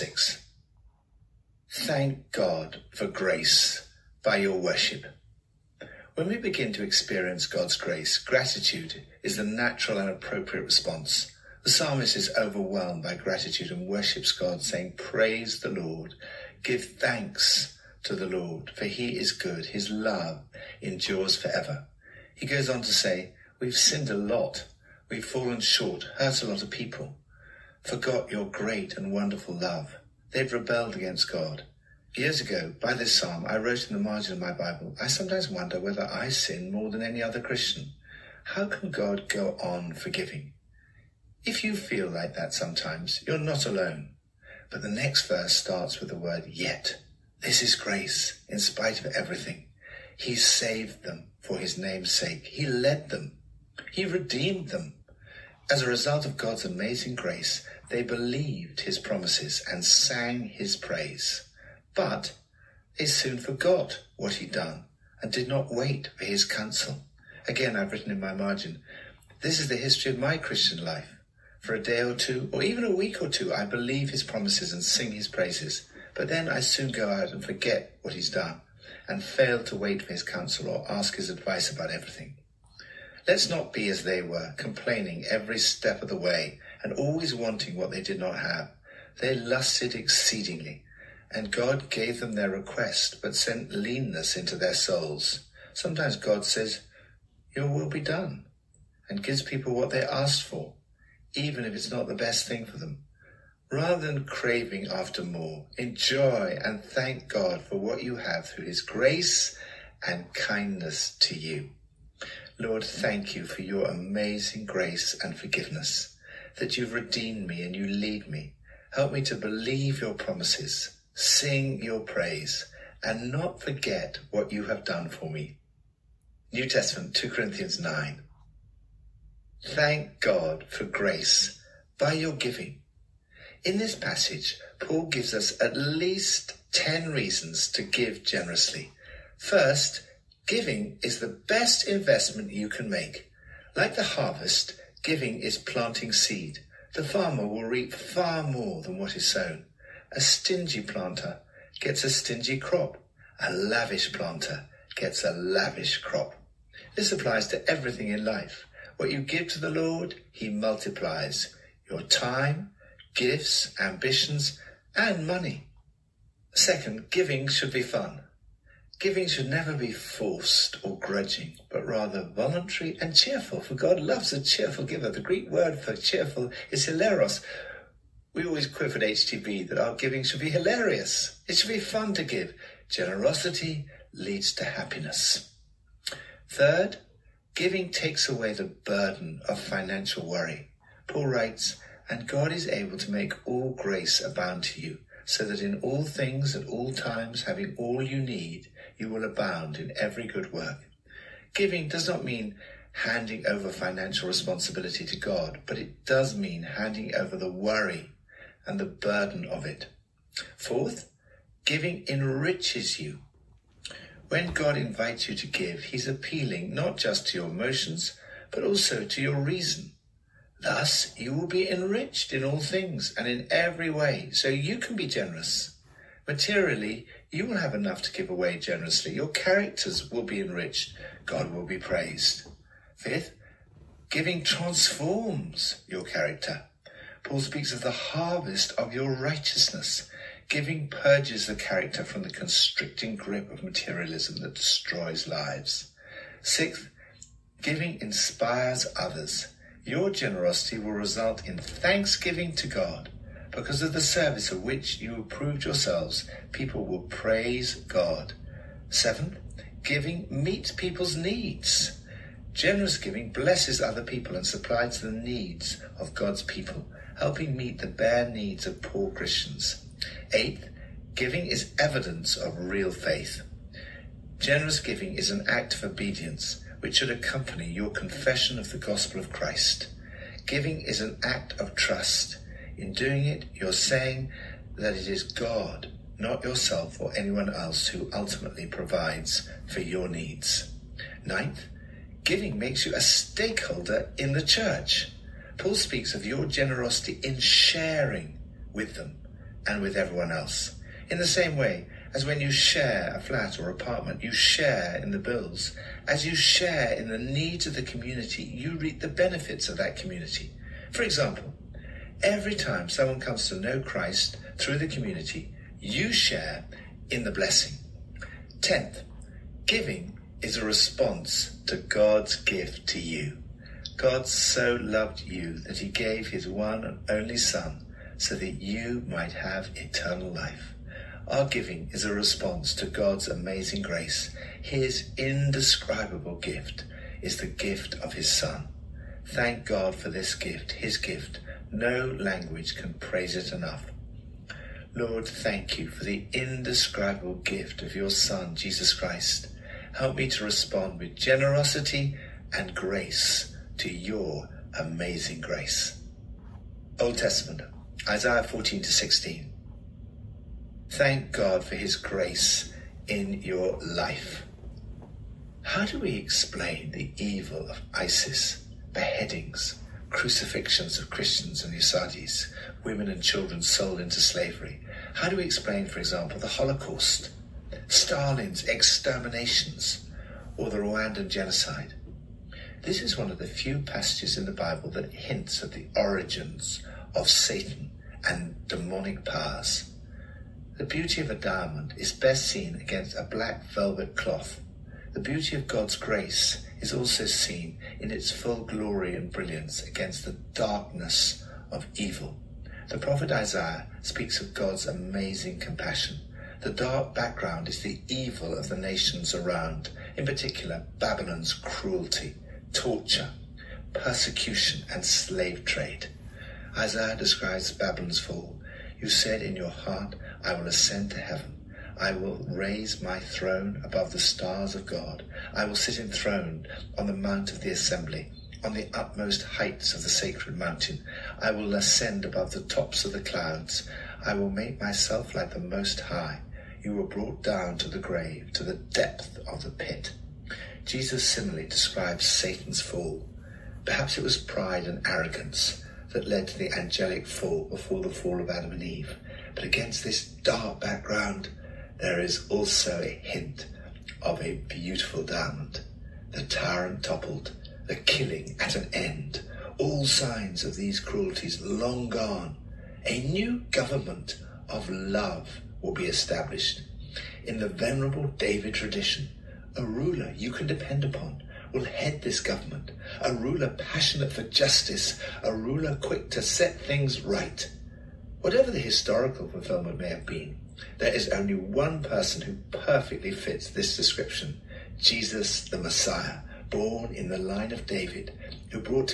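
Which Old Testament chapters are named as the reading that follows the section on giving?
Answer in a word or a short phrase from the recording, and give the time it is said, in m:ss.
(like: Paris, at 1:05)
Isaiah 14 to 16, at 5:58.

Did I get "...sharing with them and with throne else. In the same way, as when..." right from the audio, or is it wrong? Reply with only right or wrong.
wrong.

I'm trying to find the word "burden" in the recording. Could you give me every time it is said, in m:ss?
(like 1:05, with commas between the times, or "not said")
3:08, 3:29.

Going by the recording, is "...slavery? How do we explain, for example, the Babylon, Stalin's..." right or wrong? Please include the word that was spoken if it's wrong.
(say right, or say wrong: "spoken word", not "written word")
wrong: "Holocaust", not "Babylon".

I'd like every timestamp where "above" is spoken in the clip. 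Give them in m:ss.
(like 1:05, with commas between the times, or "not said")
7:03, 7:12.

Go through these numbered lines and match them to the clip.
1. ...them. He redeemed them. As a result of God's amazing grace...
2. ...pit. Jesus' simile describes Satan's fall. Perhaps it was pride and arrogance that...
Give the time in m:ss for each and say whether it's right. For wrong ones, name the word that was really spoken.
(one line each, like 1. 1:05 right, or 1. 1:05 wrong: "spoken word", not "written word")
1. 0:53 right
2. 7:19 right.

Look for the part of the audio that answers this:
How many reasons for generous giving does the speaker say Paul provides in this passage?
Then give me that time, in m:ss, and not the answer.
2:16.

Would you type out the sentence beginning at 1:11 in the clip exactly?
For a day or two, or even a week or two, I believe his promises and sing his praises.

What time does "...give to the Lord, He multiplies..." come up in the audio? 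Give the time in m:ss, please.
2:39.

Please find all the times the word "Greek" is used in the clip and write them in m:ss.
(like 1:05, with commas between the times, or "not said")
2:55.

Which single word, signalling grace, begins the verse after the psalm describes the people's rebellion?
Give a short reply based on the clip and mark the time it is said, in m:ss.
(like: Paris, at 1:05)
yet, at 0:46.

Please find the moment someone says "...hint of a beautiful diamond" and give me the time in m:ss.
7:33.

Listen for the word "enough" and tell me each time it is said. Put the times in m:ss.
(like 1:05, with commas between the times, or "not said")
3:47, 5:43.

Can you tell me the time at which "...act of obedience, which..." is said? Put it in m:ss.
4:35.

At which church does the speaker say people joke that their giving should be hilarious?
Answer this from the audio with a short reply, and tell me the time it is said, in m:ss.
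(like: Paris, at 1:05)
HTB, at 2:59.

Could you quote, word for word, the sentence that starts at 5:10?
For example, every time someone comes to know Christ through the community, you share in the blessing.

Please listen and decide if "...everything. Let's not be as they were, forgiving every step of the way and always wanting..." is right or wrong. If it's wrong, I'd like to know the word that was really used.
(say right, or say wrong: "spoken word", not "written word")
wrong: "complaining", not "forgiving".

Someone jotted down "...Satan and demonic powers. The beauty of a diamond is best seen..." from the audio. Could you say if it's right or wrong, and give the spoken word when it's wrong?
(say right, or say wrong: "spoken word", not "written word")
right.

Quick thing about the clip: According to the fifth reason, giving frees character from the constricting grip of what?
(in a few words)
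materialism.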